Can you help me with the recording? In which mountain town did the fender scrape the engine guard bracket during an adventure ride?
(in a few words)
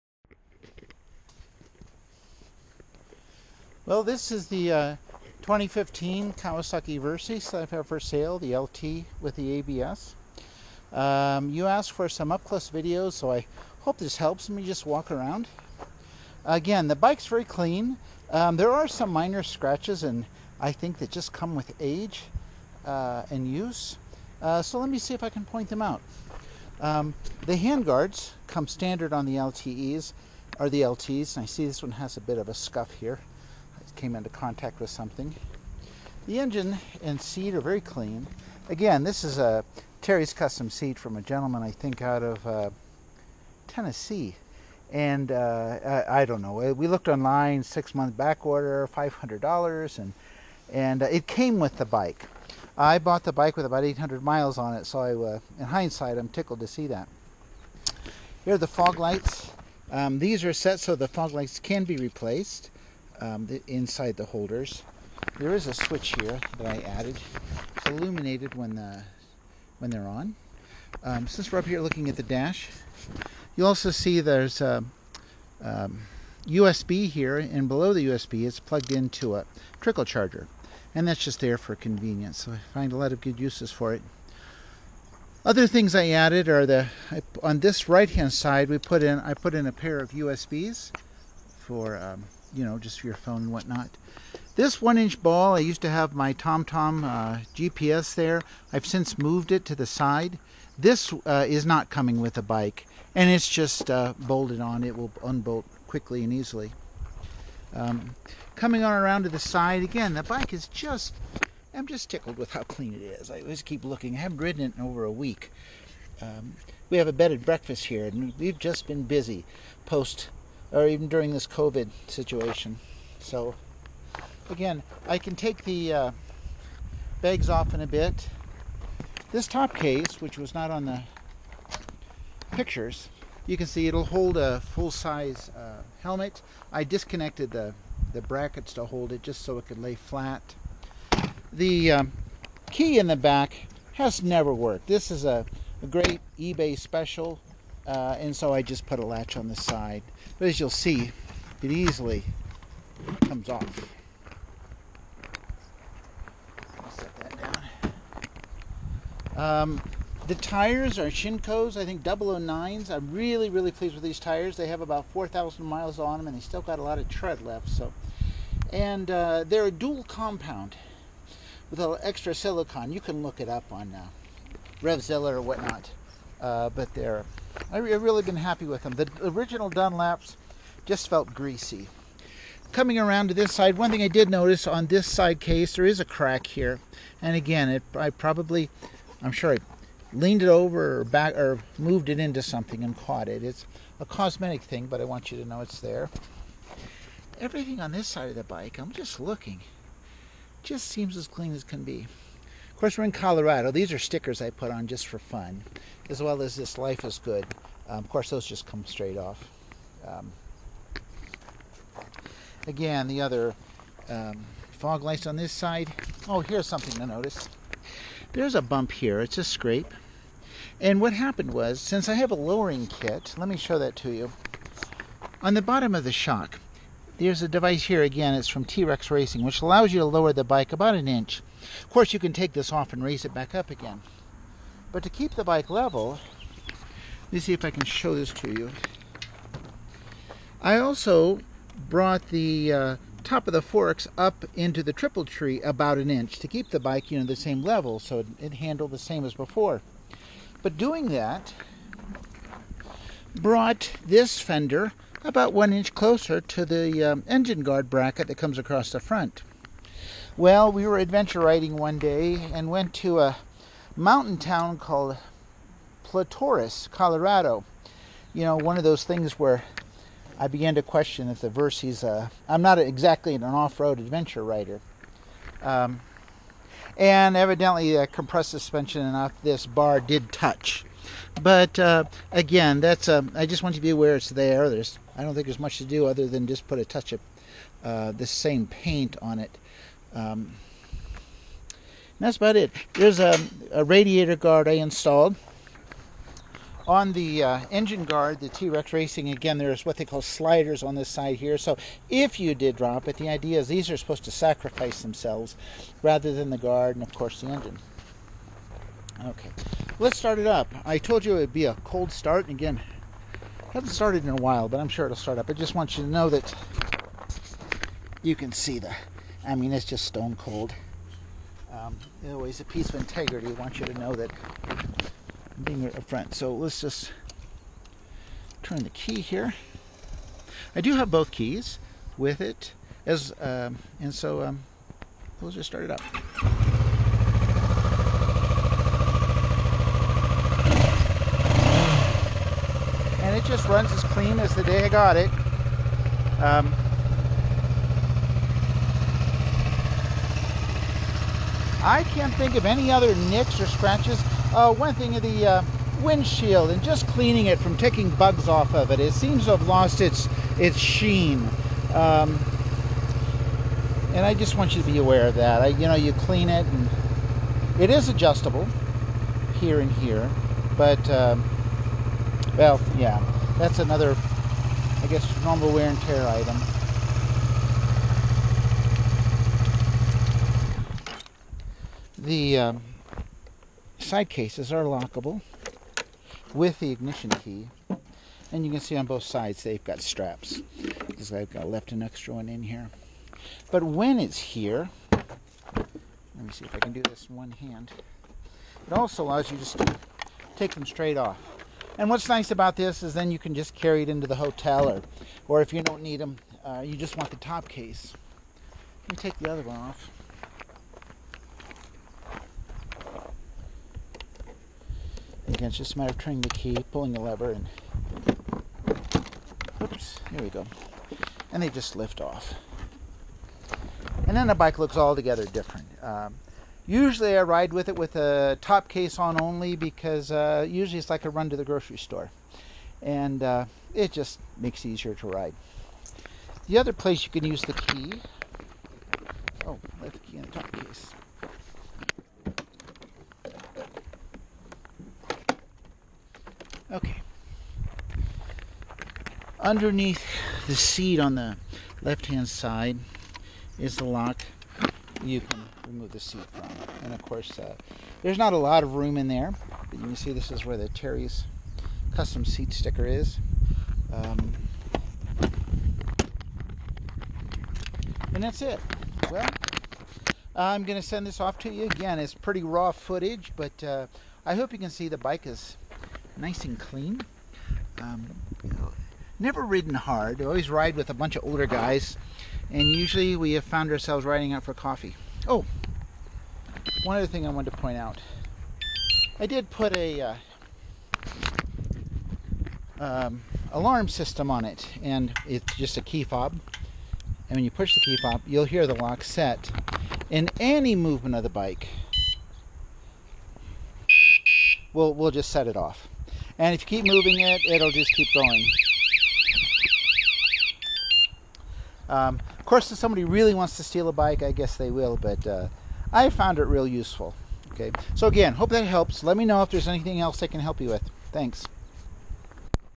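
Platoro, Colorado.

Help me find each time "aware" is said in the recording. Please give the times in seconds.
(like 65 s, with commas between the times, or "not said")
283 s, 364 s.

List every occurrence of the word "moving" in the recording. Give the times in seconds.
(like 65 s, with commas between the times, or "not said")
507 s.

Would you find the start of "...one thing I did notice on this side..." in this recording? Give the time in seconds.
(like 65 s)
183 s.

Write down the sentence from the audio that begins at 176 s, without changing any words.
Uh, but they are I've really been happy with them.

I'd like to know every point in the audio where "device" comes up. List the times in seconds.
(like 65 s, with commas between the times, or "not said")
227 s.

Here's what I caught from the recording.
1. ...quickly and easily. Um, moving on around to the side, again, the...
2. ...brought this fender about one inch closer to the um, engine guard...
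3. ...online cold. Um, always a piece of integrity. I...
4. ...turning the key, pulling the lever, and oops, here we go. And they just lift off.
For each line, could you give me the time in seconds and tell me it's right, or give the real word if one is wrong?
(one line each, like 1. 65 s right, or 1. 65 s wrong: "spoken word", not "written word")
1. 105 s wrong: "coming", not "moving"
2. 253 s right
3. 320 s wrong: "stone", not "online"
4. 416 s right.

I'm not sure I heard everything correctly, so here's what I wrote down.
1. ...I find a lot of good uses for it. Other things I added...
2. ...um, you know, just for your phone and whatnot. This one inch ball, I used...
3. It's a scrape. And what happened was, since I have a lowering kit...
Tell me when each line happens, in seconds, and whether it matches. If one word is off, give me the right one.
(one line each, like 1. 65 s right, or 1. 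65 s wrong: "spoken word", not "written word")
1. 82 s right
2. 91 s right
3. 219 s right.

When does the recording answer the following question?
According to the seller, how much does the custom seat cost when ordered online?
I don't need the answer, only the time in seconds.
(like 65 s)
48 s.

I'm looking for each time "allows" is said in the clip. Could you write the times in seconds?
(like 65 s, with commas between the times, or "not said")
229 s, 399 s.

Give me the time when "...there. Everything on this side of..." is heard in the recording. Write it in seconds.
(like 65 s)
195 s.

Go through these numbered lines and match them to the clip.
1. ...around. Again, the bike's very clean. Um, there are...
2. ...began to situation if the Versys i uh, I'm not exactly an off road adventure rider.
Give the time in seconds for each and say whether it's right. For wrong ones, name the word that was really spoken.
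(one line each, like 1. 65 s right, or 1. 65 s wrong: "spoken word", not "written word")
1. 15 s right
2. 270 s wrong: "question", not "situation".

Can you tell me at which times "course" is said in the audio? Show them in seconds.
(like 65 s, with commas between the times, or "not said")
202 s, 208 s, 231 s, 307 s, 457 s, 512 s.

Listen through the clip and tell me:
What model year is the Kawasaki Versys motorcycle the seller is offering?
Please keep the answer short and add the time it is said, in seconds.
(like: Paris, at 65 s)
2015, at 5 s.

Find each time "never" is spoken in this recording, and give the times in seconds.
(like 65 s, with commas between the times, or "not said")
144 s, 479 s.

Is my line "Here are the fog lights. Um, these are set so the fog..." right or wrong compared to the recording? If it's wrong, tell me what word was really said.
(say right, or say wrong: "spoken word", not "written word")
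right.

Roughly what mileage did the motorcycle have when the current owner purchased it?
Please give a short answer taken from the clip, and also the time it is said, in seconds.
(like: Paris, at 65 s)
800 miles, at 53 s.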